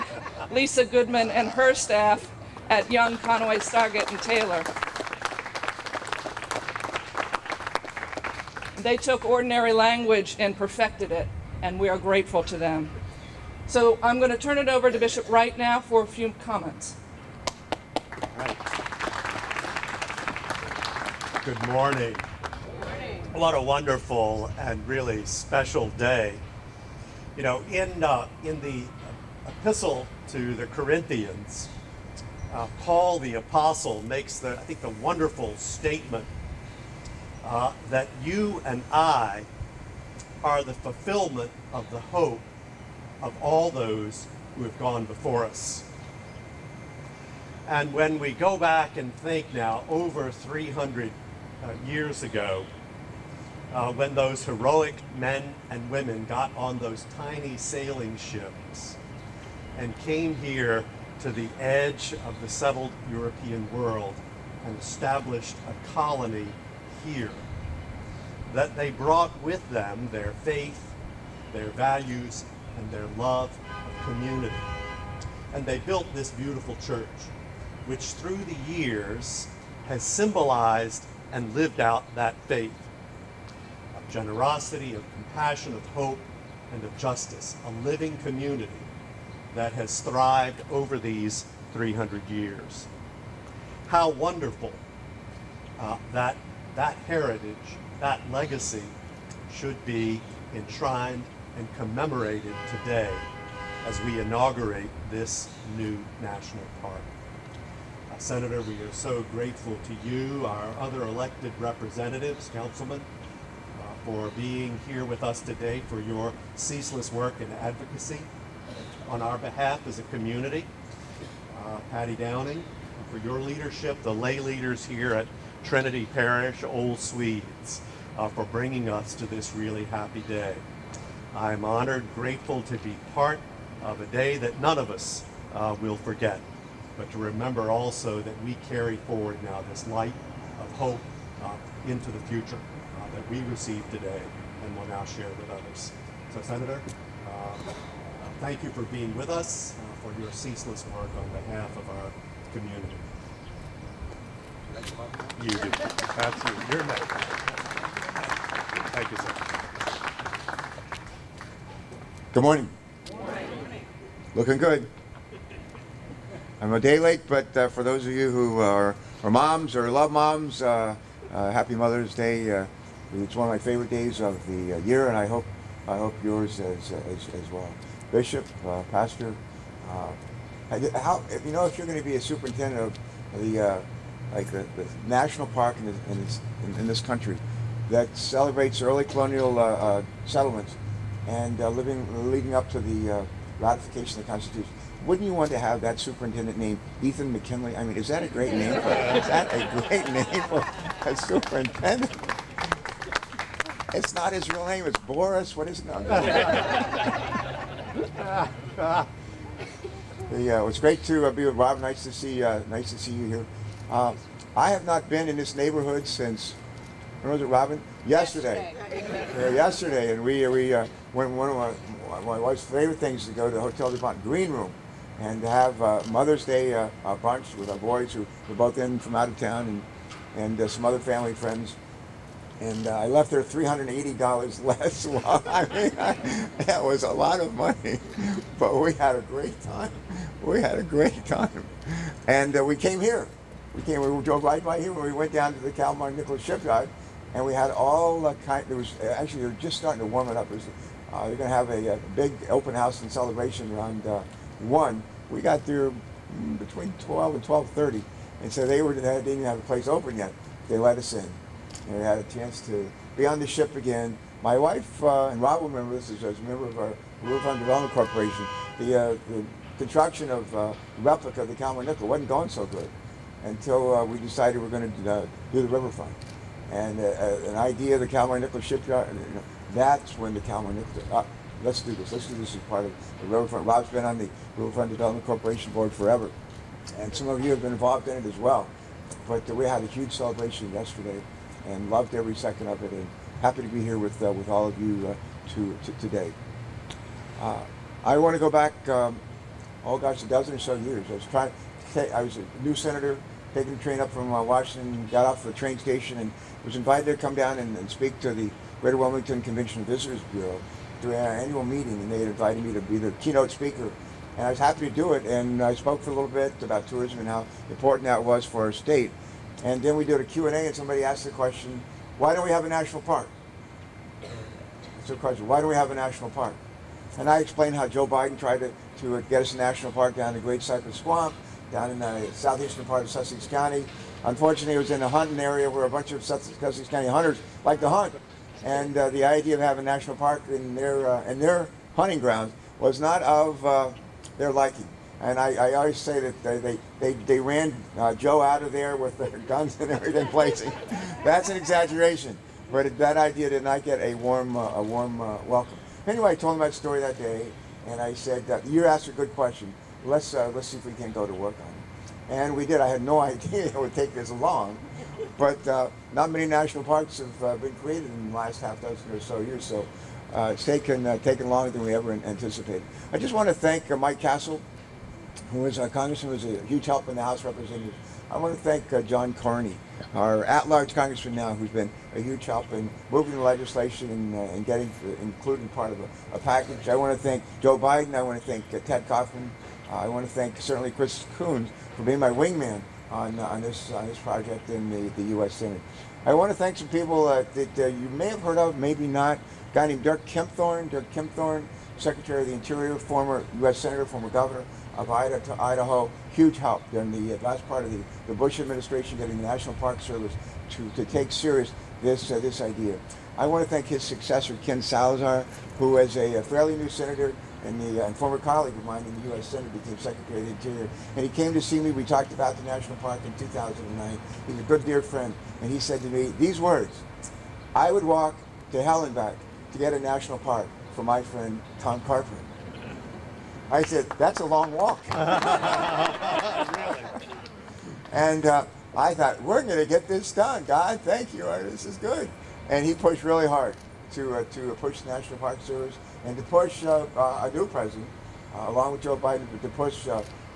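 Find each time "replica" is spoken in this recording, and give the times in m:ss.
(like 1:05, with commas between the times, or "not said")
4:31.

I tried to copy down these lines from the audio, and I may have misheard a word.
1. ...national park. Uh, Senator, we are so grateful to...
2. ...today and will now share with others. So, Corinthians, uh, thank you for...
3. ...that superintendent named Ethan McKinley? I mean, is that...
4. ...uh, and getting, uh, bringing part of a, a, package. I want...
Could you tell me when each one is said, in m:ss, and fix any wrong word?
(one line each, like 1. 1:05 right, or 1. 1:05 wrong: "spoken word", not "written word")
1. 1:46 right
2. 2:23 wrong: "Senator", not "Corinthians"
3. 3:15 right
4. 6:24 wrong: "including", not "bringing".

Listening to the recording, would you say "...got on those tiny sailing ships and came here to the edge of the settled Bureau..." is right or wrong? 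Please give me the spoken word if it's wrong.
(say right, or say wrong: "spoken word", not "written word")
wrong: "European", not "Bureau".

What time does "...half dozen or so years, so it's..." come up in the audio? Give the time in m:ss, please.
6:08.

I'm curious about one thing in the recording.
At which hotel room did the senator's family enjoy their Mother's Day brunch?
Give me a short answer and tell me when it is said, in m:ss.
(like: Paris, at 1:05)
Green room, at 3:44.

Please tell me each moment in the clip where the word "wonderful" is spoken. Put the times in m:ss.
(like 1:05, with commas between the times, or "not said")
0:23, 0:34, 1:34.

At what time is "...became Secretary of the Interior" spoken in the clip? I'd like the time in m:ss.
6:59.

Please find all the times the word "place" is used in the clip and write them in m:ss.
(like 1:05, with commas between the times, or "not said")
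4:19.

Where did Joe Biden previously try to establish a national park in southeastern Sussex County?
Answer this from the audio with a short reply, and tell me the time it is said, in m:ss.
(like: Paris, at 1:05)
Great Cypress Swamp, at 5:30.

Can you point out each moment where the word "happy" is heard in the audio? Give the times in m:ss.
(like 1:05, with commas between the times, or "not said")
2:09, 2:51, 4:53, 5:14.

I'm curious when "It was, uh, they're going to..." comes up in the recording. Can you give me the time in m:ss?
4:10.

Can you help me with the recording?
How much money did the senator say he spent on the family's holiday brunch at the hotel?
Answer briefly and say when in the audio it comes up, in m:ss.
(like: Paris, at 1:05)
$380, at 3:53.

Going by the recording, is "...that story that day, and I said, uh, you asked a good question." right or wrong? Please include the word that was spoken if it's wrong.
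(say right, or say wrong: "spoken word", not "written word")
right.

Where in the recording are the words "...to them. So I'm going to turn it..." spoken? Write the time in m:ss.
0:12.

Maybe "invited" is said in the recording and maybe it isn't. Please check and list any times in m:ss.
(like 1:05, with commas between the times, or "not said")
5:06, 5:12.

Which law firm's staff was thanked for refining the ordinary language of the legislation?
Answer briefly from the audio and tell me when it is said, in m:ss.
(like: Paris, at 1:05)
Young, Conaway, Stargatt, and Taylor, at 0:02.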